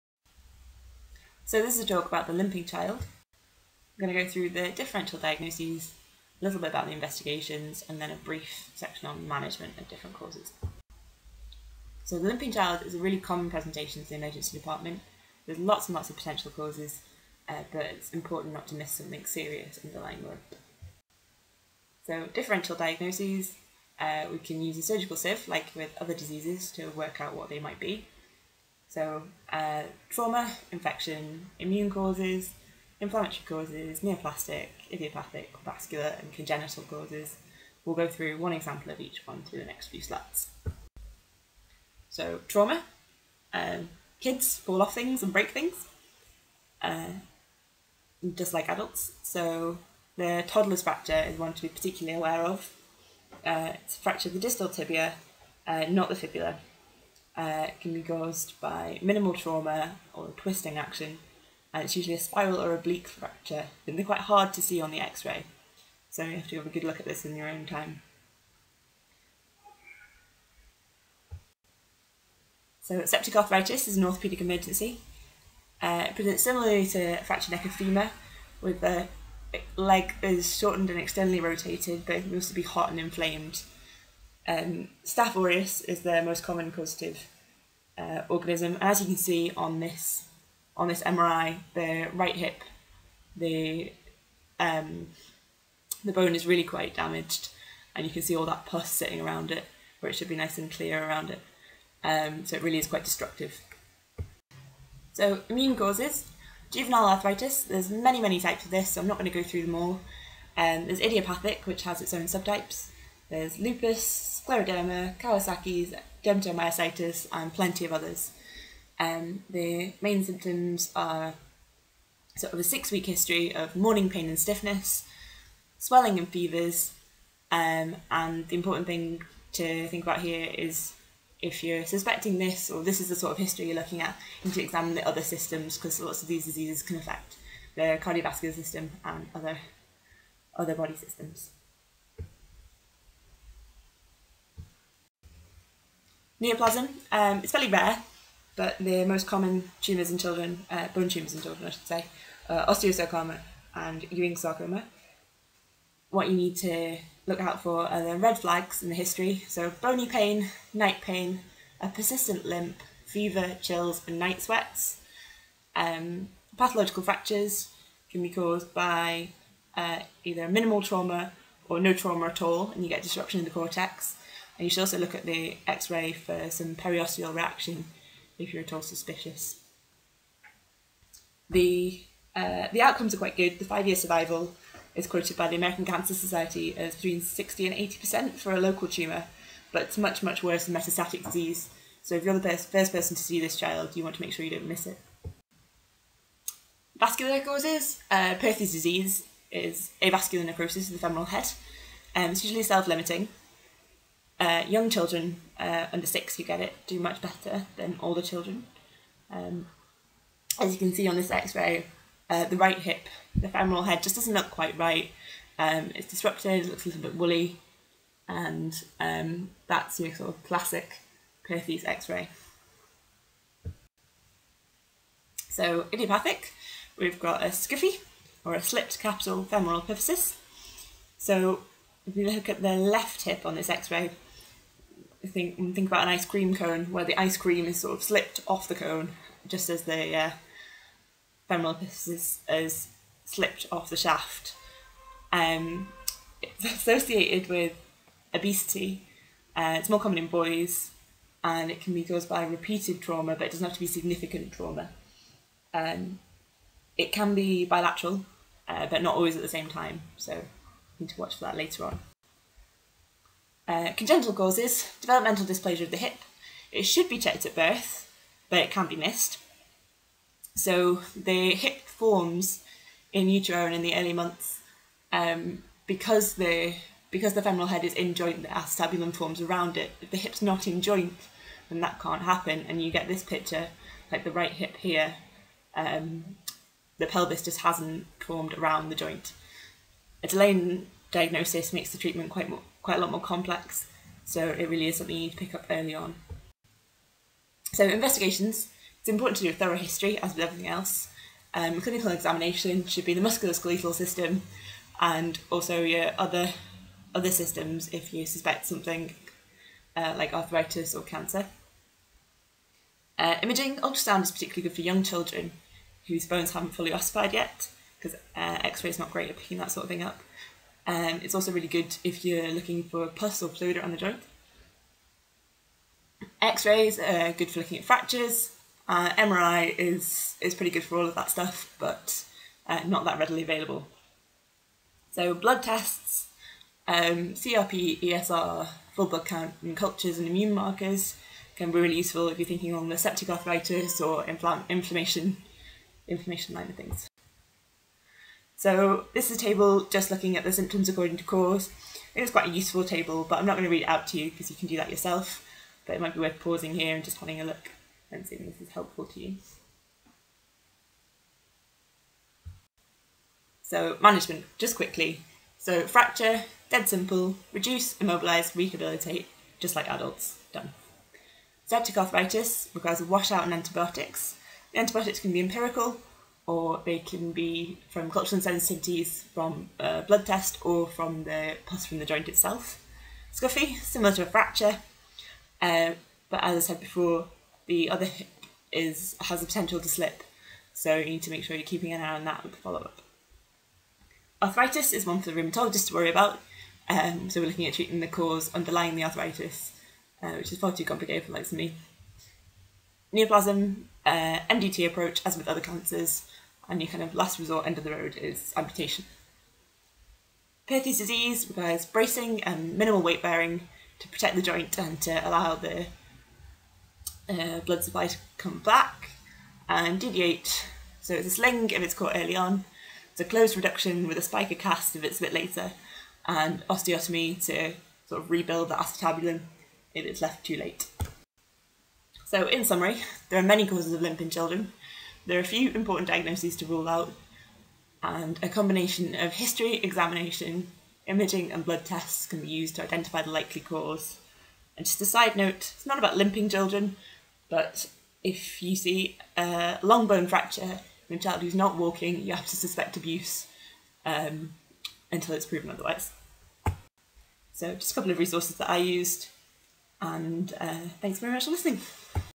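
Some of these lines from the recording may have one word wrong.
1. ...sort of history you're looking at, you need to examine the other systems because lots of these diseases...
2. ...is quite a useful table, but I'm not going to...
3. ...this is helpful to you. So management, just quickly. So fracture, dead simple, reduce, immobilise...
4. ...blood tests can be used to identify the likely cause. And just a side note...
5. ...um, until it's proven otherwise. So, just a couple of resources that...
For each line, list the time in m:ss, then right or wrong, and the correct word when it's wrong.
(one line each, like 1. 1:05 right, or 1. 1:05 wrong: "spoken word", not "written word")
1. 2:13 right
2. 5:52 right
3. 5:58 right
4. 7:21 right
5. 7:34 right.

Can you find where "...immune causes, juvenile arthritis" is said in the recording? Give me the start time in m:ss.
1:45.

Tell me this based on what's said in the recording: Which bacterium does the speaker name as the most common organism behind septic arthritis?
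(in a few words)
Staph aureus.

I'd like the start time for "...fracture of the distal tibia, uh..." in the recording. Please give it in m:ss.
0:54.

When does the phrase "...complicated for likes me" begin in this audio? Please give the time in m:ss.
6:40.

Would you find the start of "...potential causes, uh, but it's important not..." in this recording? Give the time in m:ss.
0:16.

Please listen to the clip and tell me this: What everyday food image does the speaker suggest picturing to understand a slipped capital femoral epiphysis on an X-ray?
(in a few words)
ice cream cone.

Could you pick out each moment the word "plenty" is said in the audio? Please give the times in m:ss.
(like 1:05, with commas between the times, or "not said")
1:57.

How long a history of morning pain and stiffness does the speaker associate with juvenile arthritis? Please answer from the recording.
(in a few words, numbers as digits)
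6 weeks.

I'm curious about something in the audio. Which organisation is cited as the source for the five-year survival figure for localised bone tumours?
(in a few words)
American Cancer Society.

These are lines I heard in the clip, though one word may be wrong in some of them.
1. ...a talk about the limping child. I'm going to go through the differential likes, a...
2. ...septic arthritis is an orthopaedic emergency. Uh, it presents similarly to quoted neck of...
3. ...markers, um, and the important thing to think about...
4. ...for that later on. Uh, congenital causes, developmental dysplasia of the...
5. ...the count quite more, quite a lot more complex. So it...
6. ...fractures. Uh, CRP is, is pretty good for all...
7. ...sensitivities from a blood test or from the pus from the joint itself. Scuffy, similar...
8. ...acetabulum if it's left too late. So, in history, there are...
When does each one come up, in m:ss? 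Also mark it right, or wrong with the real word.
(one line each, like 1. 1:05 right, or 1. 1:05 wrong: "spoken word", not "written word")
1. 0:01 wrong: "diagnoses", not "likes"
2. 1:13 wrong: "fractured", not "quoted"
3. 2:06 wrong: "fevers", not "markers"
4. 4:21 right
5. 4:51 wrong: "treatment", not "count"
6. 5:27 wrong: "MRI", not "CRP"
7. 6:18 right
8. 7:08 wrong: "summary", not "history".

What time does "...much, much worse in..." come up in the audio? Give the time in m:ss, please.
3:09.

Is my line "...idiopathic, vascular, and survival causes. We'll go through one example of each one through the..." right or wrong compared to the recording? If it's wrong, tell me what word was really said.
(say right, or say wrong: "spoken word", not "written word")
wrong: "congenital", not "survival".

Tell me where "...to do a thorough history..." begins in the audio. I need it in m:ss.
4:59.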